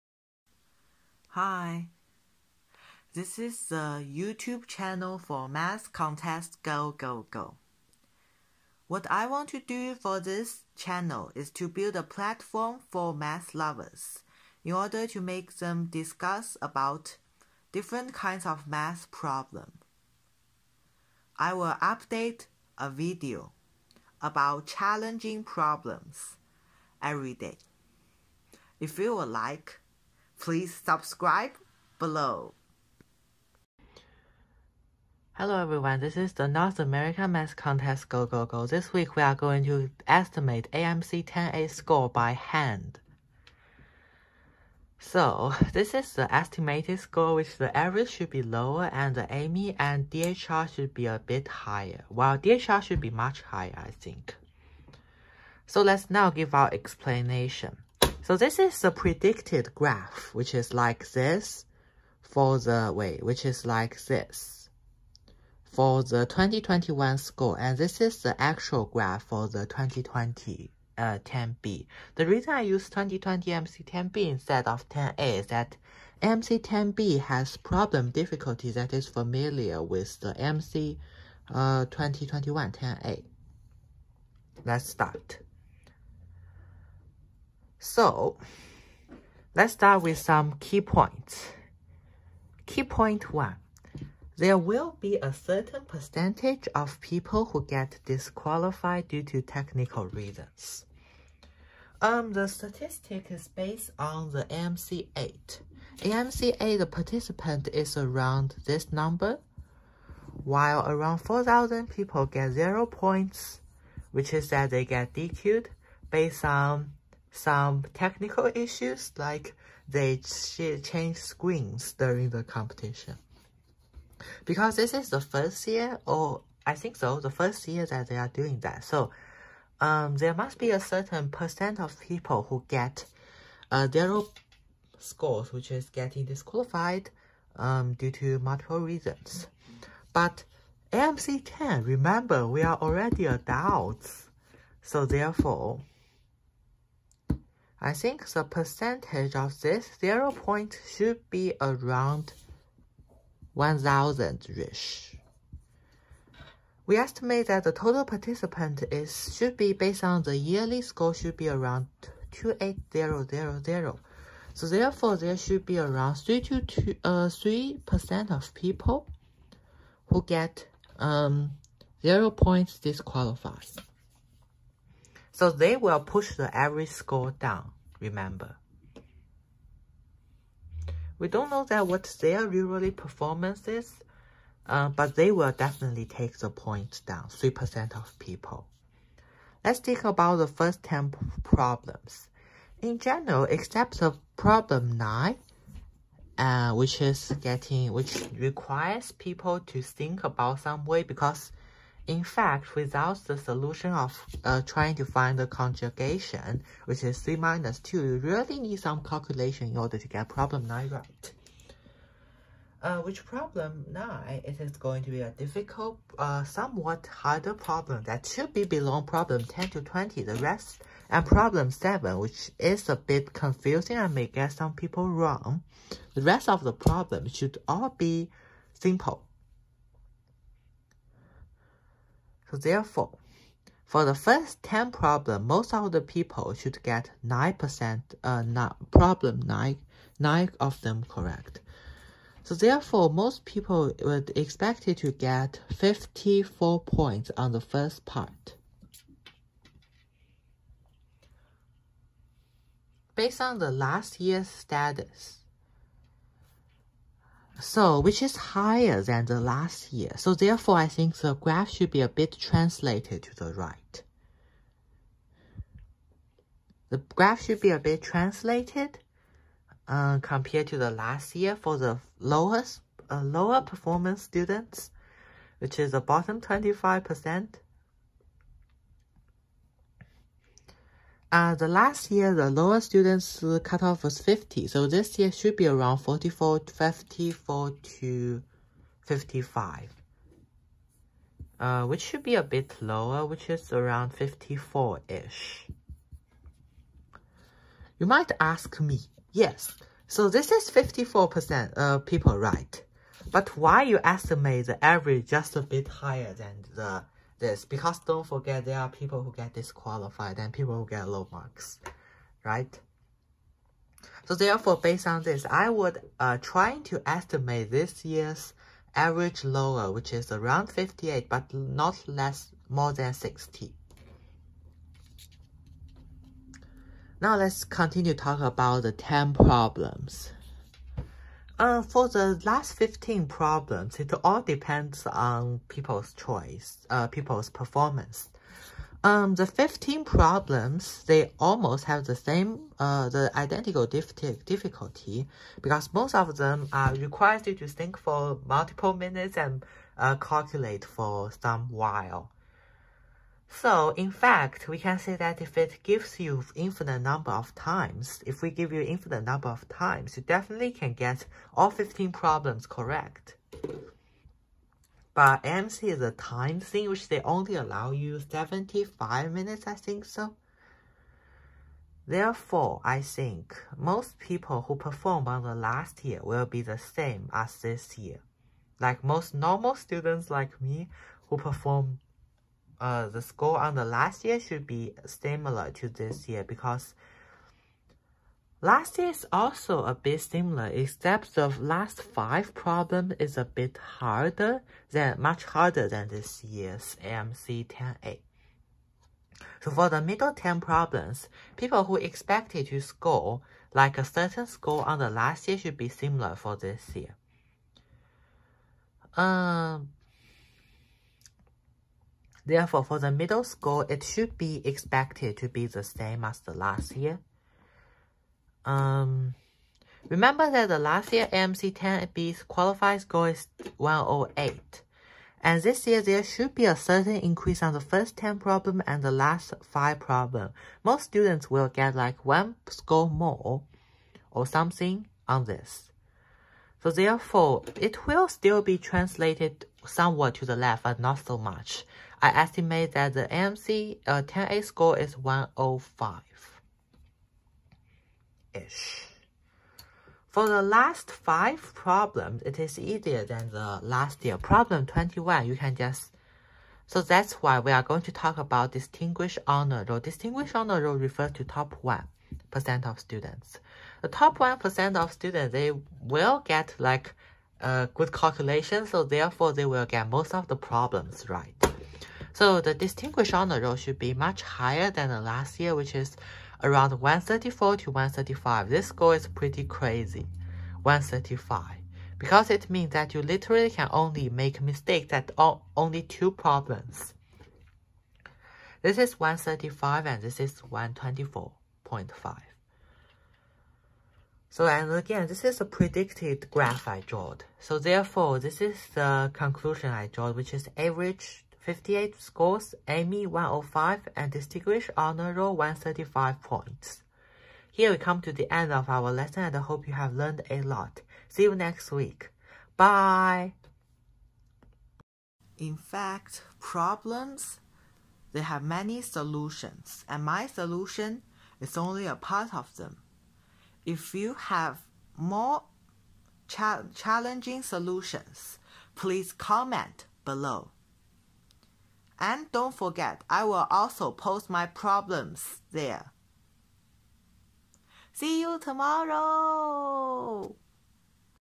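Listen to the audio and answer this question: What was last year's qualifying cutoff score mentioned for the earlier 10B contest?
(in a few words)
108.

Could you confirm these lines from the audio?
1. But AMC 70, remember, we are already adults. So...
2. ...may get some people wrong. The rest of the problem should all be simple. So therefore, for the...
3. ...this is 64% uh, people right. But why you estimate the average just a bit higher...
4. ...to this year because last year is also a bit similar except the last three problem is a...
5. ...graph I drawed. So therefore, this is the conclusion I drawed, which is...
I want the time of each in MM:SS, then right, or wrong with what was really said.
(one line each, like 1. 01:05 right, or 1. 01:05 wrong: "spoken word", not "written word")
1. 02:20 wrong: "10", not "70"
2. 03:44 right
3. 05:00 wrong: "54", not "64"
4. 06:25 wrong: "five", not "three"
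5. 08:16 right.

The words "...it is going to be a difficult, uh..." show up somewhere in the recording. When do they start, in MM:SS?
03:34.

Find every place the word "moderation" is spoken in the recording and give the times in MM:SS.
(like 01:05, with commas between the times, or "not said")
not said.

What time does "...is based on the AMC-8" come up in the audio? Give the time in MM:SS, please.
01:43.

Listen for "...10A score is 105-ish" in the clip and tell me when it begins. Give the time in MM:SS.
07:24.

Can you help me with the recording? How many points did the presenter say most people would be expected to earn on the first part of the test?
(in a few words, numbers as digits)
54.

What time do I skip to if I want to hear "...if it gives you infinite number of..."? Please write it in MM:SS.
05:55.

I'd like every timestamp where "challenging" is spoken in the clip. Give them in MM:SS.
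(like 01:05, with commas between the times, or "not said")
00:24, 08:46.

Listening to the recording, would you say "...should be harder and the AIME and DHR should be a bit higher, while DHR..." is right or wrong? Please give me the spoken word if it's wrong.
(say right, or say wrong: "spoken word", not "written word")
wrong: "lower", not "harder".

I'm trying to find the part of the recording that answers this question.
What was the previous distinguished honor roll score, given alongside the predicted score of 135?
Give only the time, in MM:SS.
08:10.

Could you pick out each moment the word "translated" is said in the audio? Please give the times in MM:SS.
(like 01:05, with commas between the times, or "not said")
04:22, 04:28, 07:18.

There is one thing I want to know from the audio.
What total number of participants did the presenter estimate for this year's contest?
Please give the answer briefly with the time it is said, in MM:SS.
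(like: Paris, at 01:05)
28000, at 02:42.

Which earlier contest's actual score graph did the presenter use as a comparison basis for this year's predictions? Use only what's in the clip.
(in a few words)
2020 AMC 10B.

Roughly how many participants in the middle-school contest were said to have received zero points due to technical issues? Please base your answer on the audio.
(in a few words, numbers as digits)
4,000.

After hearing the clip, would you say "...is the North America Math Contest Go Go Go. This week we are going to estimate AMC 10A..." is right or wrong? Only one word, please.
right.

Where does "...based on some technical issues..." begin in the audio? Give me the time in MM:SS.
01:56.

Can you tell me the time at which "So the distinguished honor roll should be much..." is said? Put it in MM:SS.
07:52.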